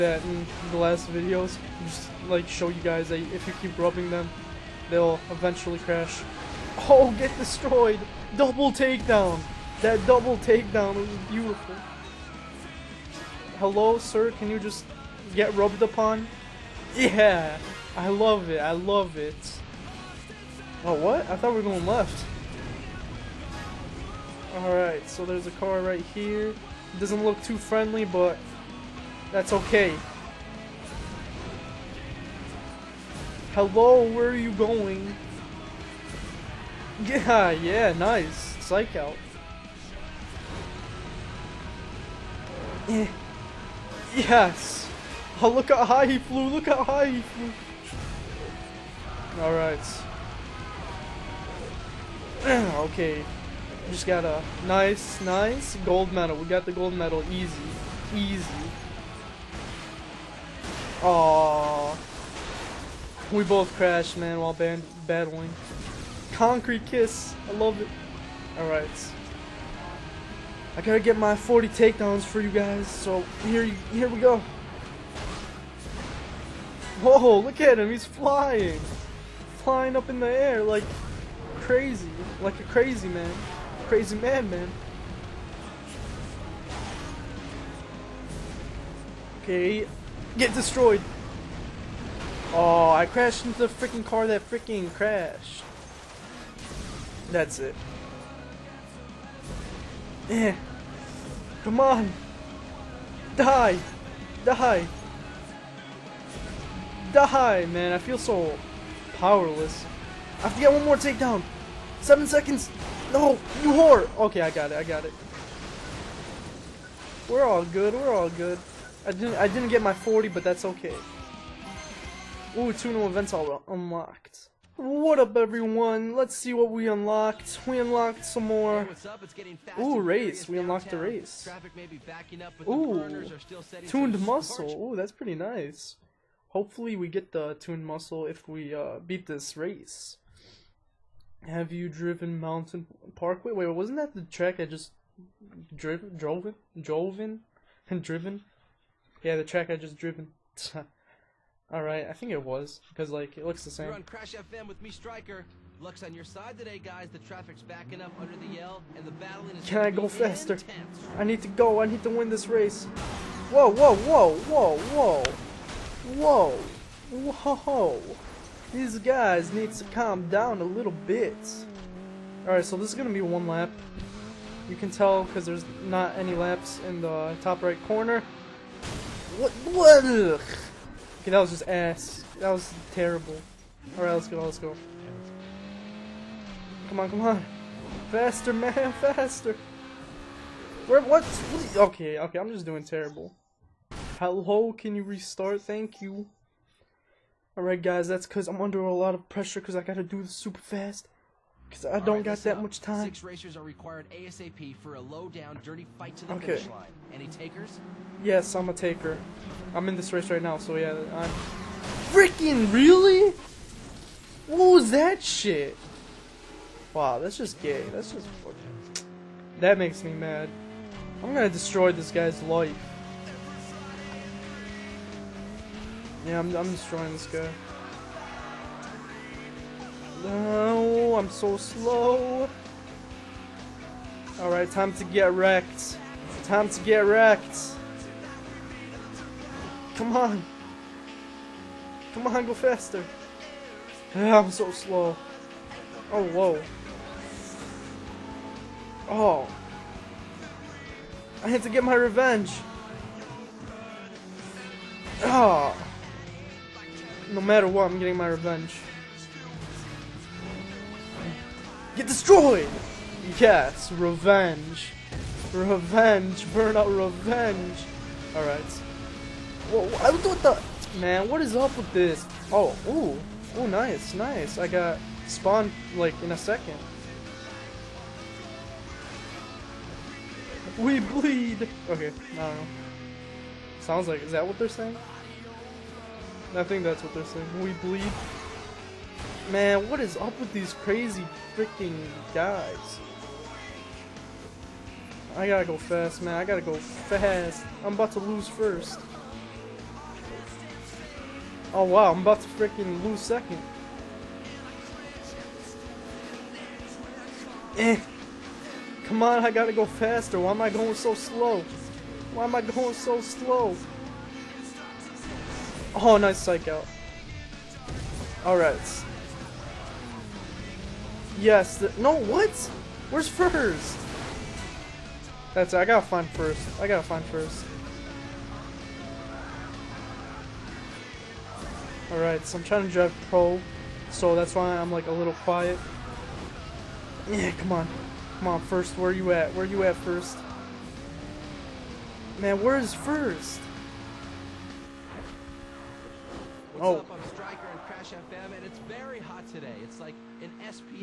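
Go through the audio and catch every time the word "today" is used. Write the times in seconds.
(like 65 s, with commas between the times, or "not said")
156 s, 349 s.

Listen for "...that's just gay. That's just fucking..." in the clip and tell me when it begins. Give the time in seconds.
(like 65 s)
217 s.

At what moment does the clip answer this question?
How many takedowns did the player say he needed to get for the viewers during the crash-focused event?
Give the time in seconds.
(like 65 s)
71 s.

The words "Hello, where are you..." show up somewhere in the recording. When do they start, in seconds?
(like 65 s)
33 s.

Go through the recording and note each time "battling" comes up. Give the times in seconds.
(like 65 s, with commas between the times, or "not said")
65 s, 159 s.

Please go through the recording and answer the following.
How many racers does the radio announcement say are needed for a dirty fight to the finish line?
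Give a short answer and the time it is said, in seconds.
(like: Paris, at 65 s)
6, at 203 s.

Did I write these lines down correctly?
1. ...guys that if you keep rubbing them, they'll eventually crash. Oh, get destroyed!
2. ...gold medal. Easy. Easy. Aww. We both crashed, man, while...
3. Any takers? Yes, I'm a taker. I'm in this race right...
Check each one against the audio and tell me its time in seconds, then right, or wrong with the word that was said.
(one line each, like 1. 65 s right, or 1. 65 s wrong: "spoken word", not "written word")
1. 2 s right
2. 56 s right
3. 207 s right.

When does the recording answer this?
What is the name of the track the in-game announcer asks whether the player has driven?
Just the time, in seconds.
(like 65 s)
142 s.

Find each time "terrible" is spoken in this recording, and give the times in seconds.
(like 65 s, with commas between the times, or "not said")
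182 s, 192 s.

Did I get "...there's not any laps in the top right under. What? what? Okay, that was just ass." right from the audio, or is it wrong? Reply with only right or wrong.
wrong.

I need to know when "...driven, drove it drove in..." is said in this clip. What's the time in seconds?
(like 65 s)
145 s.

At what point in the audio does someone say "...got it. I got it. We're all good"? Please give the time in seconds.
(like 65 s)
114 s.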